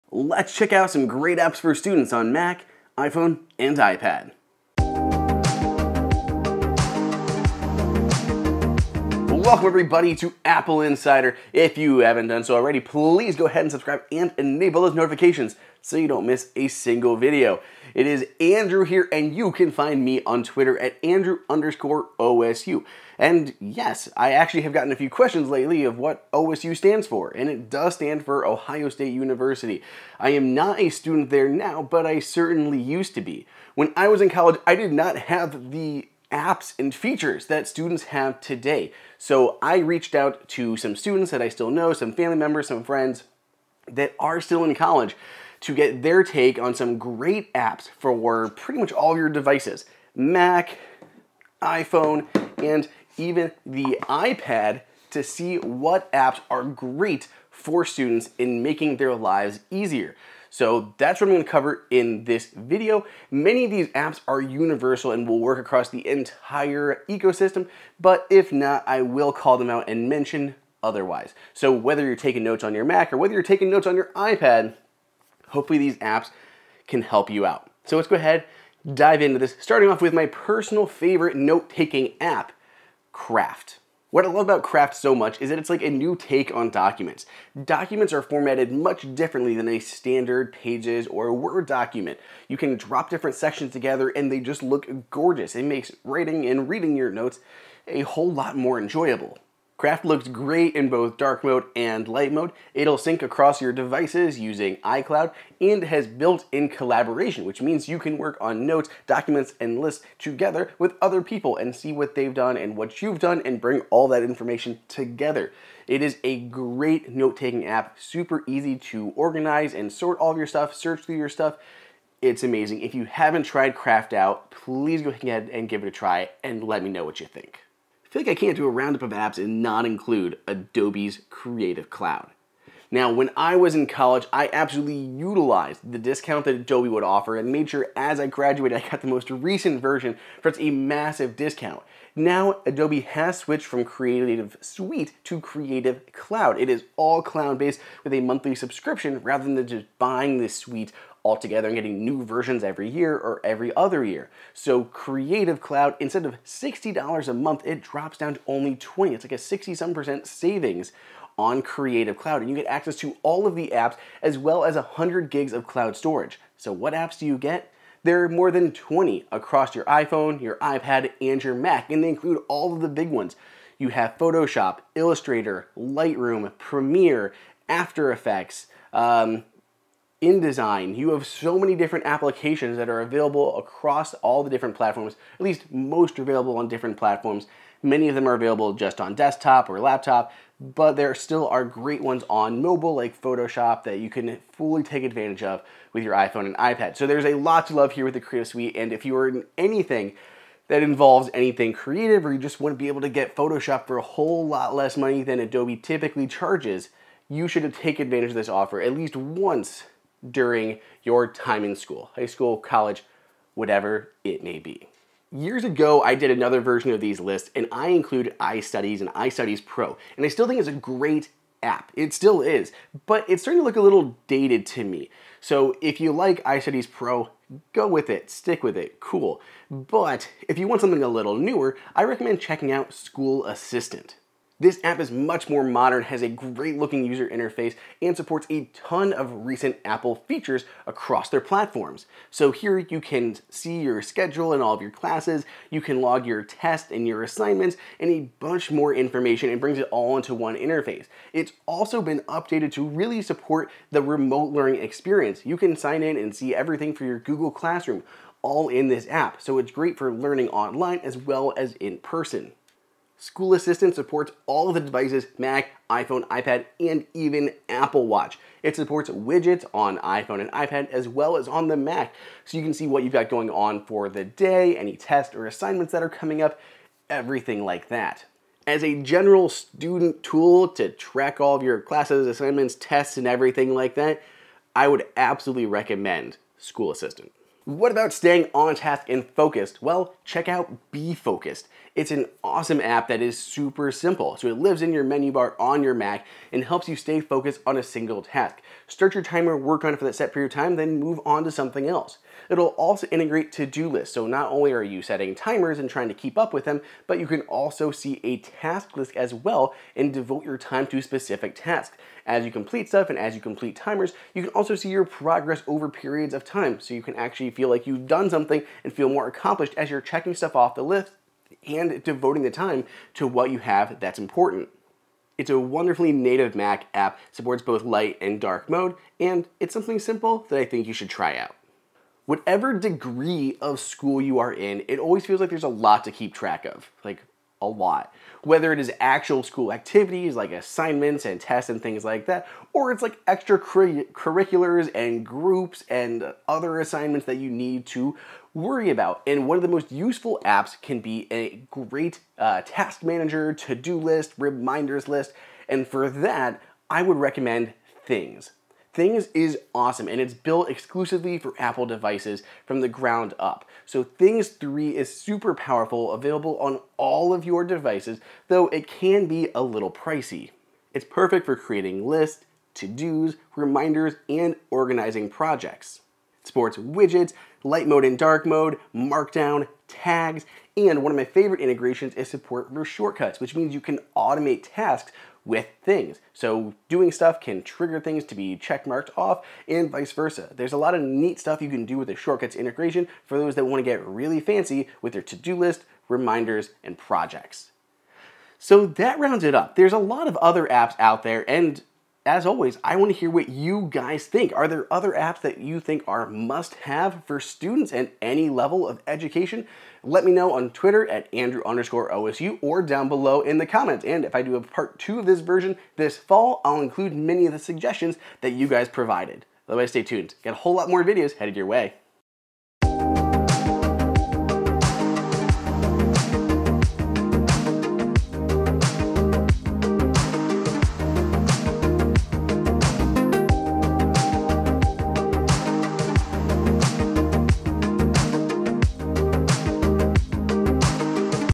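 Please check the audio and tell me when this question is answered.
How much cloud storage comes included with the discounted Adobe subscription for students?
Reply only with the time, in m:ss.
2:44.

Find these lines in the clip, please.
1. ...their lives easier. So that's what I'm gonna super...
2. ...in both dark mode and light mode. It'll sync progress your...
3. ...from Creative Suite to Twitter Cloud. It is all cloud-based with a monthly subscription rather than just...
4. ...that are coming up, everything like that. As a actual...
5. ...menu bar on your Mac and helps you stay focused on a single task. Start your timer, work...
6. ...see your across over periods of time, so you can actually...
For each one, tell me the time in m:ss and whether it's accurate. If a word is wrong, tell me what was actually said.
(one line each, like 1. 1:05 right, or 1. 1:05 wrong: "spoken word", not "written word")
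1. 0:58 wrong: "cover", not "super"
2. 1:40 wrong: "across", not "progress"
3. 2:23 wrong: "Creative", not "Twitter"
4. 4:35 wrong: "general", not "actual"
5. 4:55 right
6. 5:14 wrong: "progress", not "across".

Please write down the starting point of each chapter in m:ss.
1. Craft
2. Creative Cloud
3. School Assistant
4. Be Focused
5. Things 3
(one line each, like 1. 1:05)
1. 1:18
2. 2:07
3. 3:35
4. 4:47
5. 5:31.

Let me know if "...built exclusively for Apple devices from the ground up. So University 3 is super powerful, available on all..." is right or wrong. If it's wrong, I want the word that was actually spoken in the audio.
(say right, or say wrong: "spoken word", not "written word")
wrong: "Things", not "University".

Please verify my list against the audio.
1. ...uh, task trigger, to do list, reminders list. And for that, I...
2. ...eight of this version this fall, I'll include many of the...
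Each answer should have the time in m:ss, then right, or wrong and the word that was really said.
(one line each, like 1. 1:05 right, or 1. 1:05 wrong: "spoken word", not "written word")
1. 5:52 wrong: "manager", not "trigger"
2. 6:54 wrong: "two", not "eight".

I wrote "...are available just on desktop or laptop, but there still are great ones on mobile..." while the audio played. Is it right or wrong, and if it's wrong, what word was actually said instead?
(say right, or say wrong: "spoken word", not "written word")
right.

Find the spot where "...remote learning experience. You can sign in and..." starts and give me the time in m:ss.
4:14.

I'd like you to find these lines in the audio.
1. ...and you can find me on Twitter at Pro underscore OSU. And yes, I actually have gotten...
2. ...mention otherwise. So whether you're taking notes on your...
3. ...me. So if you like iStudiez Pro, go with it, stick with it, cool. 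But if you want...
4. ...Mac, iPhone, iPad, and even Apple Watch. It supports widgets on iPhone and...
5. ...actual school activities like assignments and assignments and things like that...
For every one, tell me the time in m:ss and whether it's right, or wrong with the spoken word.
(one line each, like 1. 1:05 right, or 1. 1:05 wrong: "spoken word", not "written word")
1. 0:19 wrong: "Andrew", not "Pro"
2. 1:10 right
3. 3:44 right
4. 4:25 right
5. 5:39 wrong: "tests", not "assignments".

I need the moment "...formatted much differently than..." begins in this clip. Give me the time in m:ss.
1:28.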